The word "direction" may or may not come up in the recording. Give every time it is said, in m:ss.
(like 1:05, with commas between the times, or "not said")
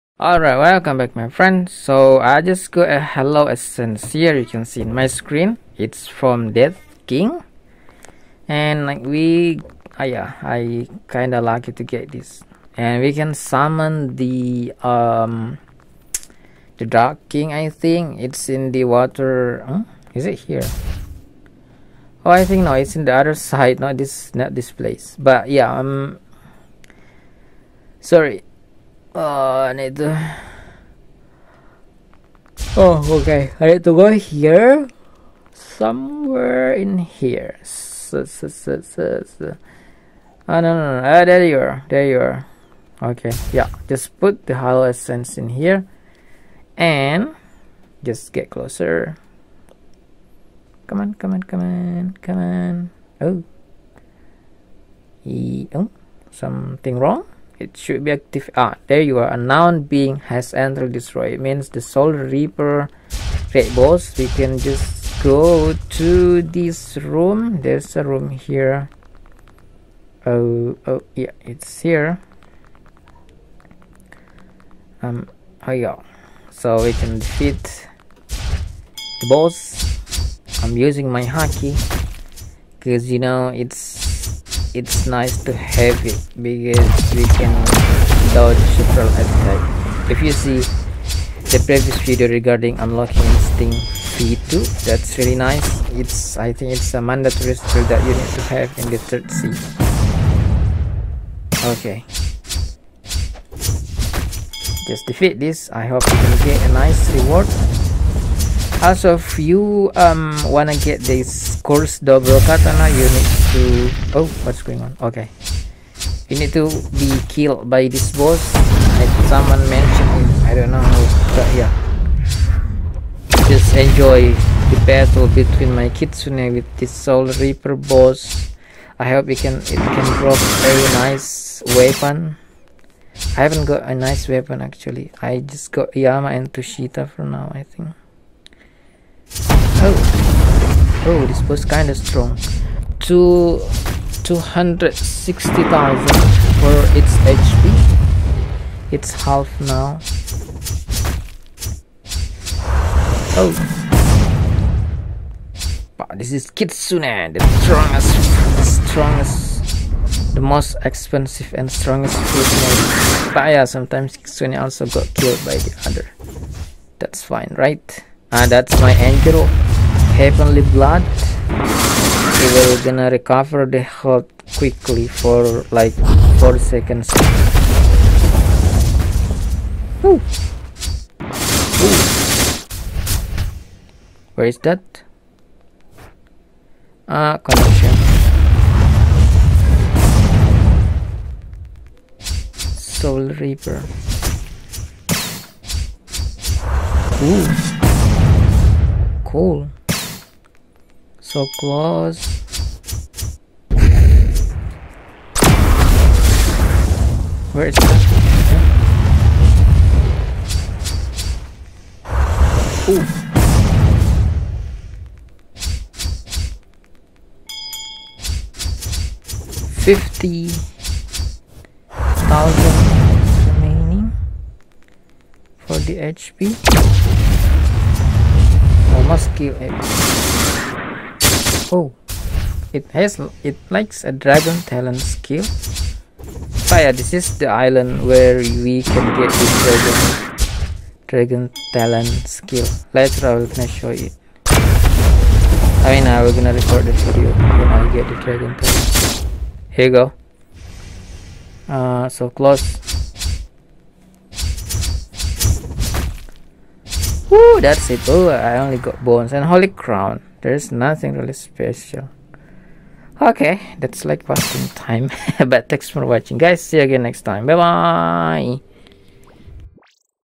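not said.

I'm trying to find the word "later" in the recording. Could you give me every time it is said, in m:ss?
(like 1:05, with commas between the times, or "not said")
4:02.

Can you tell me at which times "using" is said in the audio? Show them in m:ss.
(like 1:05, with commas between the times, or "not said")
1:20.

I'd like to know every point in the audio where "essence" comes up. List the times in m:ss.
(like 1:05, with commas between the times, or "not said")
0:03, 0:44.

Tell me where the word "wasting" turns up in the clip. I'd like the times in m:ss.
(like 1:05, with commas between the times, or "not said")
4:24.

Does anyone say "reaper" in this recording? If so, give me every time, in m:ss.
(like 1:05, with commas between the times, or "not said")
1:02, 2:07, 3:13.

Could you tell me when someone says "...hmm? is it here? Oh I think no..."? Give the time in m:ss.
0:19.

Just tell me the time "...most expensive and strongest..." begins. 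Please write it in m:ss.
2:40.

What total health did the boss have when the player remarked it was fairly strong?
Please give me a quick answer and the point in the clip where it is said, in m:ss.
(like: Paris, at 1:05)
260,000, at 2:22.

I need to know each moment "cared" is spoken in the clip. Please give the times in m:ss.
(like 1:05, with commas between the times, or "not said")
not said.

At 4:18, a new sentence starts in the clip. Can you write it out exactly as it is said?
Oh, I only got bones and holy crown.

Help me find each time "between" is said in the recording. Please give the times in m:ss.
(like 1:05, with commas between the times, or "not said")
2:05.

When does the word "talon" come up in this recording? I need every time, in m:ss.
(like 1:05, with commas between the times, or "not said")
3:54, 4:01, 4:08.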